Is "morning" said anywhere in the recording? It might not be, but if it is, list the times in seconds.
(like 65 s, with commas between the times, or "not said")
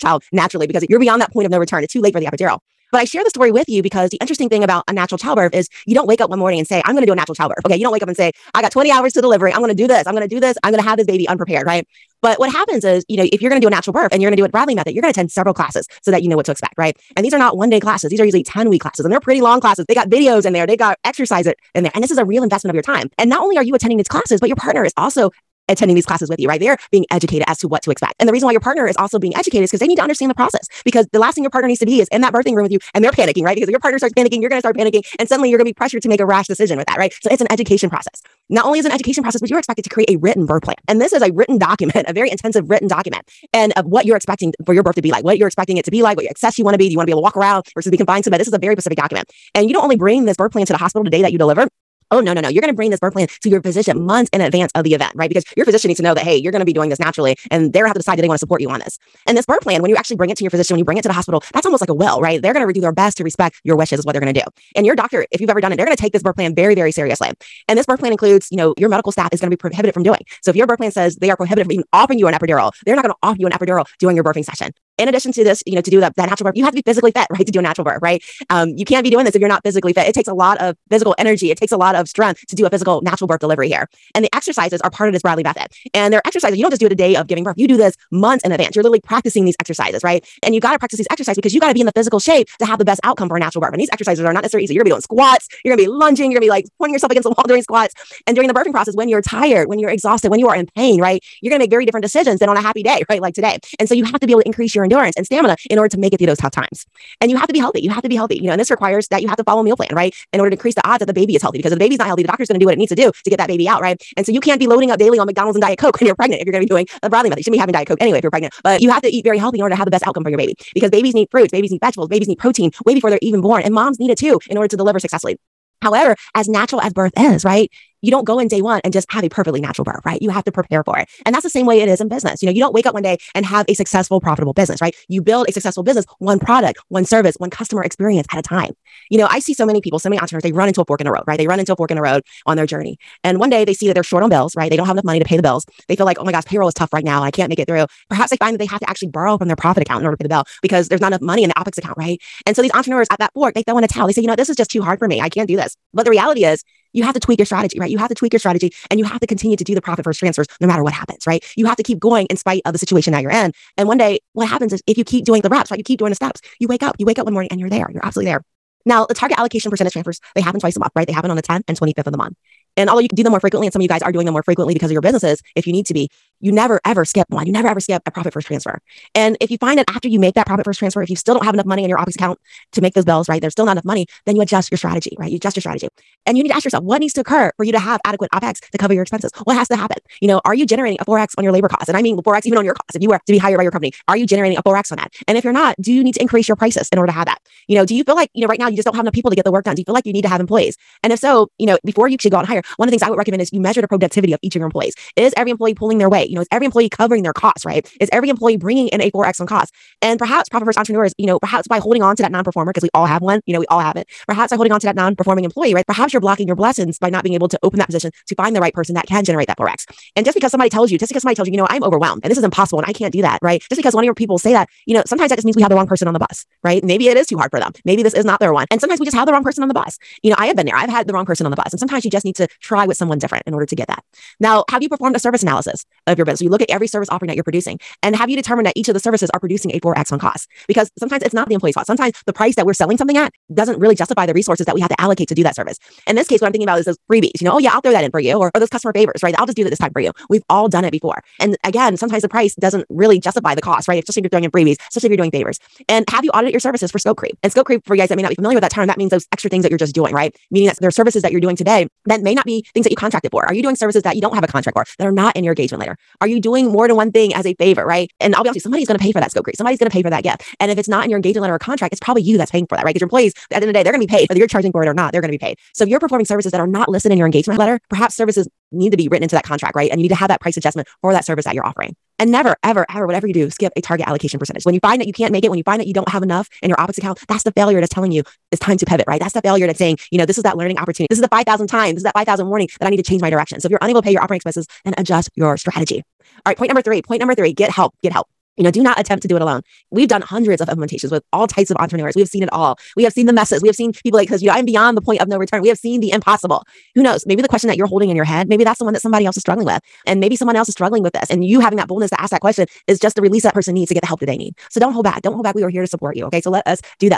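6 s, 167 s.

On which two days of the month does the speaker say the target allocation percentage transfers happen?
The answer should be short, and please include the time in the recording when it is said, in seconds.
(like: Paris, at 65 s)
10th and 25th, at 171 s.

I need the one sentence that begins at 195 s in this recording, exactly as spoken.
And if you're not, do you need to increase your prices in order to have that?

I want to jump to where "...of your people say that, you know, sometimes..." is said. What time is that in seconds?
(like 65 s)
224 s.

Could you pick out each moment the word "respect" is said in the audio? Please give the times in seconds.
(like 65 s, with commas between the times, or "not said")
63 s.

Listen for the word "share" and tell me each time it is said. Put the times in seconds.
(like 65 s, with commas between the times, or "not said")
3 s.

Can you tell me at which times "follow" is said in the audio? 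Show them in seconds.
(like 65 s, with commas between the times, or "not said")
109 s.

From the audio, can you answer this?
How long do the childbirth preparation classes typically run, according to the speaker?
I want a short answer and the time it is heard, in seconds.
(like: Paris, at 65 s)
10 weeks, at 18 s.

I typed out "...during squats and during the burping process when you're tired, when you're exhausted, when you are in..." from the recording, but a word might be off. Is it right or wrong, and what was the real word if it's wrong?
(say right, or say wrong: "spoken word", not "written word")
right.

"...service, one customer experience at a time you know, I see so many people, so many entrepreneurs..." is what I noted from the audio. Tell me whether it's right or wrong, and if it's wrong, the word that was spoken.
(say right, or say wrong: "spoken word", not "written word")
right.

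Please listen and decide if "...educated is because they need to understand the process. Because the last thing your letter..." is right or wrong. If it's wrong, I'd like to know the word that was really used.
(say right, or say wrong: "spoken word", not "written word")
wrong: "partner", not "letter".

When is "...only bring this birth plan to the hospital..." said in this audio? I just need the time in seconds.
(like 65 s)
49 s.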